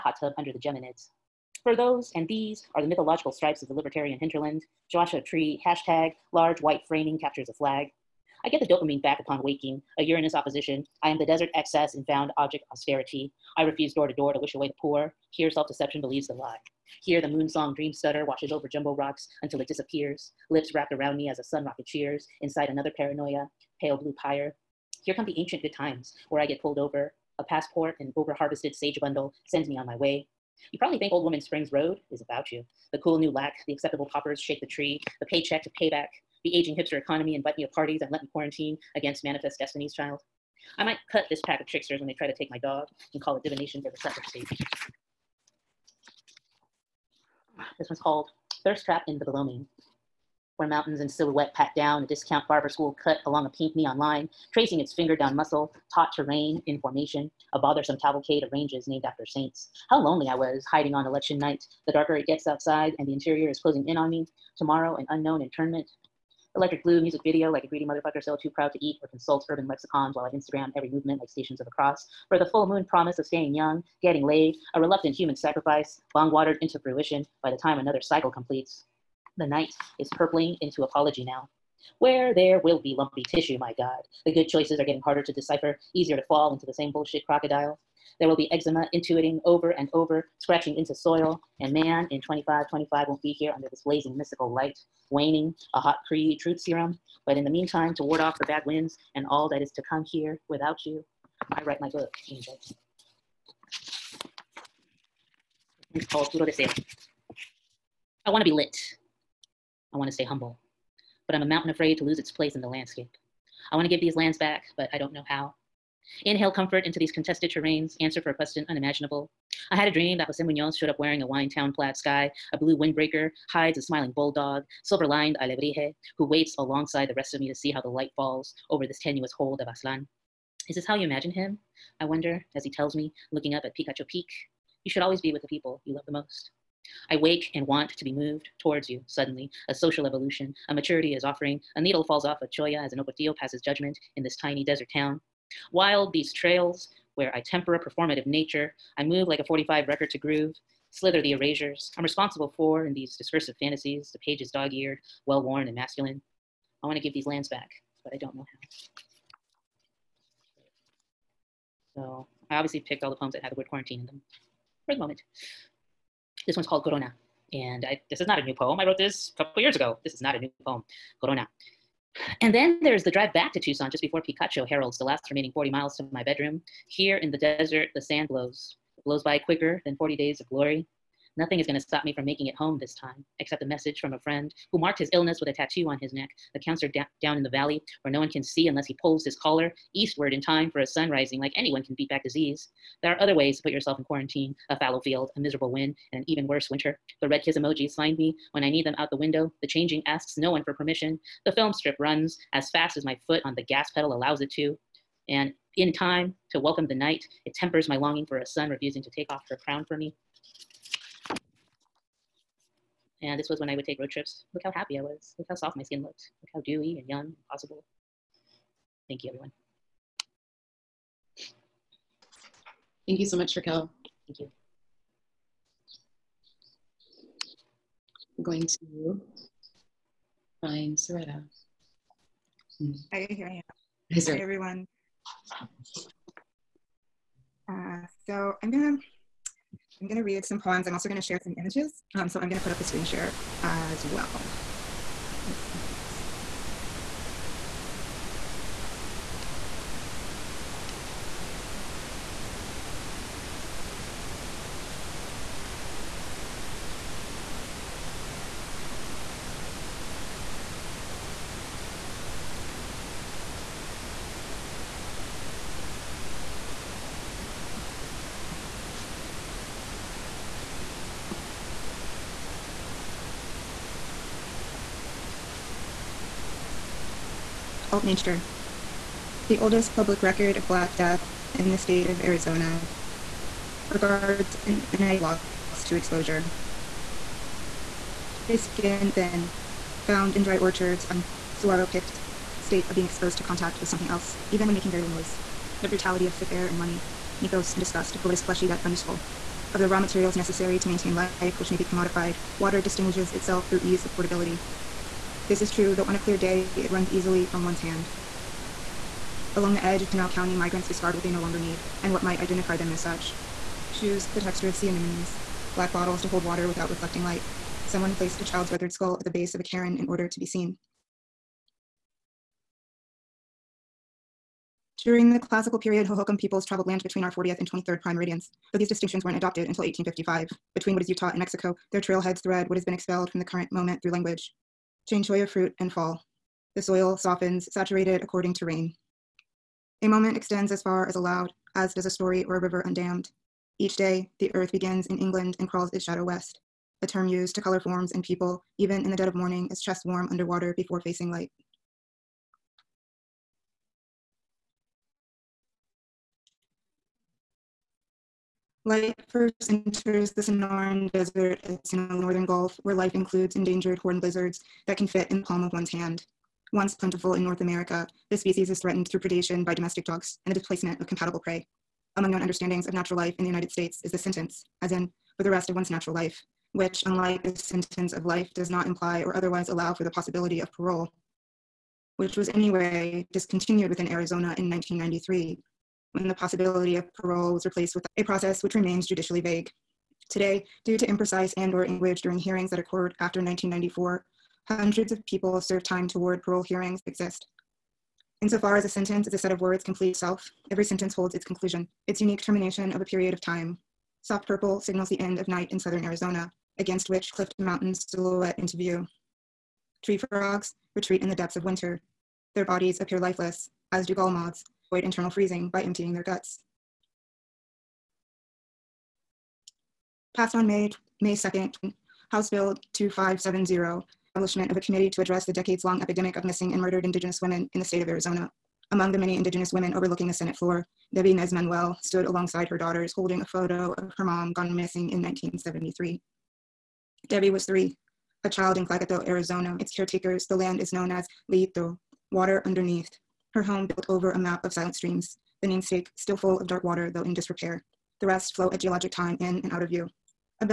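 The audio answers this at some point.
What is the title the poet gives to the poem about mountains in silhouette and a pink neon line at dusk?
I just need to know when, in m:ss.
0:48.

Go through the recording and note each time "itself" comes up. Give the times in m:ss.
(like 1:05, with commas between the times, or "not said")
5:03, 6:40.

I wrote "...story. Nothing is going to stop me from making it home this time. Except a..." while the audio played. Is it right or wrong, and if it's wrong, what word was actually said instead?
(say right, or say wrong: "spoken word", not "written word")
wrong: "glory", not "story".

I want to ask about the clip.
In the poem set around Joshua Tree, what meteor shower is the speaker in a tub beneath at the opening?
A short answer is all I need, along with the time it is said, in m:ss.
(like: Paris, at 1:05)
Geminids, at 0:00.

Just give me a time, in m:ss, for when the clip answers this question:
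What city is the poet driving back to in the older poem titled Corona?
2:53.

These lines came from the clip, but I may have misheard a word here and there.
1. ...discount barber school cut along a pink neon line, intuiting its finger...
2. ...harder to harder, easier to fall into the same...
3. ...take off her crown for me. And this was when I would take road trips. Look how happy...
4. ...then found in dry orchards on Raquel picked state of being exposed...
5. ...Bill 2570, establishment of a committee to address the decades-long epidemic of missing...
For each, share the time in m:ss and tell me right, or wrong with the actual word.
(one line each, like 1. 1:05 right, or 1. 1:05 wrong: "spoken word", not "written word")
1. 0:52 wrong: "tracing", not "intuiting"
2. 1:24 wrong: "decipher", not "harder"
3. 3:29 right
4. 4:49 wrong: "Saguaro", not "Raquel"
5. 7:02 right.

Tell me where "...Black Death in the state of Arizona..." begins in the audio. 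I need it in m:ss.
4:40.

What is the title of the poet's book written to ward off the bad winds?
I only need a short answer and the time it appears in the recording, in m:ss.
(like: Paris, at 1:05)
Puro Deseo, at 1:46.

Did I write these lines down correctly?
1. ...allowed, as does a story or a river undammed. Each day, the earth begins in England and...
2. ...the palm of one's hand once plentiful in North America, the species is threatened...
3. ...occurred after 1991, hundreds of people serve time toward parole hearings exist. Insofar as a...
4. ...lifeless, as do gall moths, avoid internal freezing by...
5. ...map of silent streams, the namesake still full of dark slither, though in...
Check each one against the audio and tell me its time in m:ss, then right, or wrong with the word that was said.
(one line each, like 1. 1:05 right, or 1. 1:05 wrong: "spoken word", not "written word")
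1. 5:41 right
2. 6:05 right
3. 6:32 wrong: "1994", not "1991"
4. 6:53 right
5. 7:24 wrong: "water", not "slither".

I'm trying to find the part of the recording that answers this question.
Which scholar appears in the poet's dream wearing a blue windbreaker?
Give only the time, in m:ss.
2:00.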